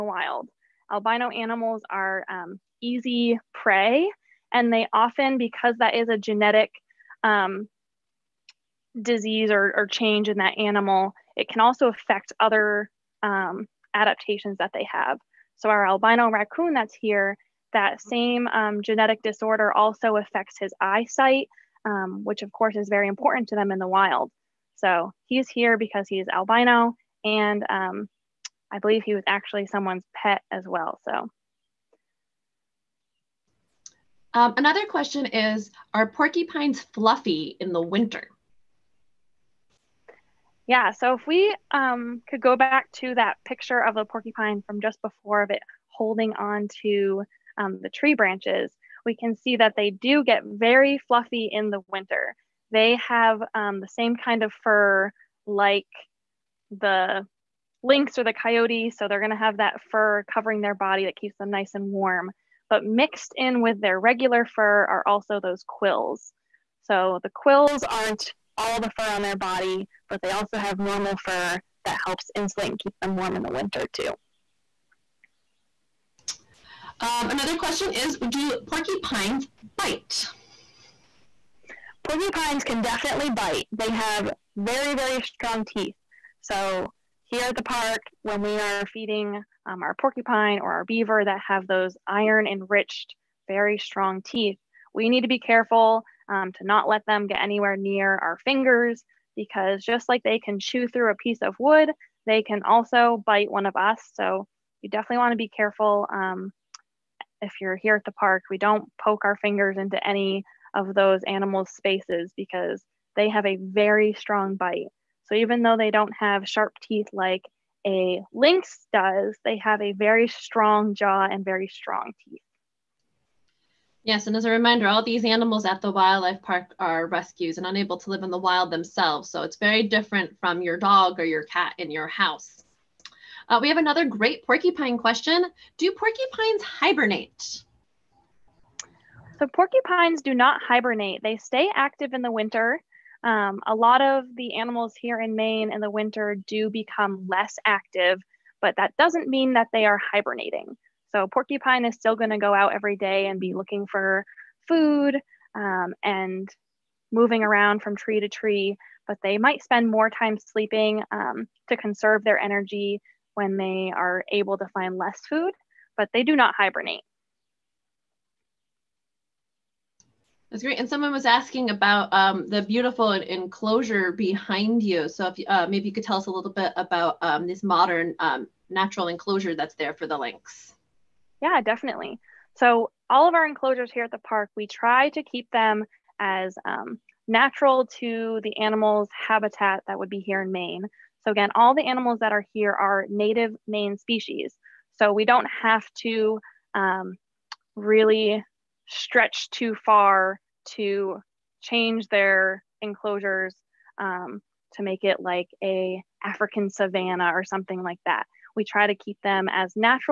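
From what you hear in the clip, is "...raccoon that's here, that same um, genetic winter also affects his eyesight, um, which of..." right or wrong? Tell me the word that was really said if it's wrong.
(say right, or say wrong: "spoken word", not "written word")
wrong: "disorder", not "winter".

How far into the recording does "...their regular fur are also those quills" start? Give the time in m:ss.
1:03.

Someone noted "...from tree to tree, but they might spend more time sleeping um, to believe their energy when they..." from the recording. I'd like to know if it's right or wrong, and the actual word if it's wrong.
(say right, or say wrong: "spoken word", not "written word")
wrong: "conserve", not "believe".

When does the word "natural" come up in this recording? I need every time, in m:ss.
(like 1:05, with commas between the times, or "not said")
2:58, 3:07.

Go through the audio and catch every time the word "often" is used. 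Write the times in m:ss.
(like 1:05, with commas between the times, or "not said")
0:04.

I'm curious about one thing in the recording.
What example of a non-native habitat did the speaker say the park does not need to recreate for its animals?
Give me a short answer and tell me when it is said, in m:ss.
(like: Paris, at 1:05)
African savanna, at 3:26.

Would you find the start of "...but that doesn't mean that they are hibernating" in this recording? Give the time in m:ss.
2:28.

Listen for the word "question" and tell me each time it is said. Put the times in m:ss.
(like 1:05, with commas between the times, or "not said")
0:34, 1:17, 2:14.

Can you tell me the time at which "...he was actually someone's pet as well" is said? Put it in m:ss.
0:29.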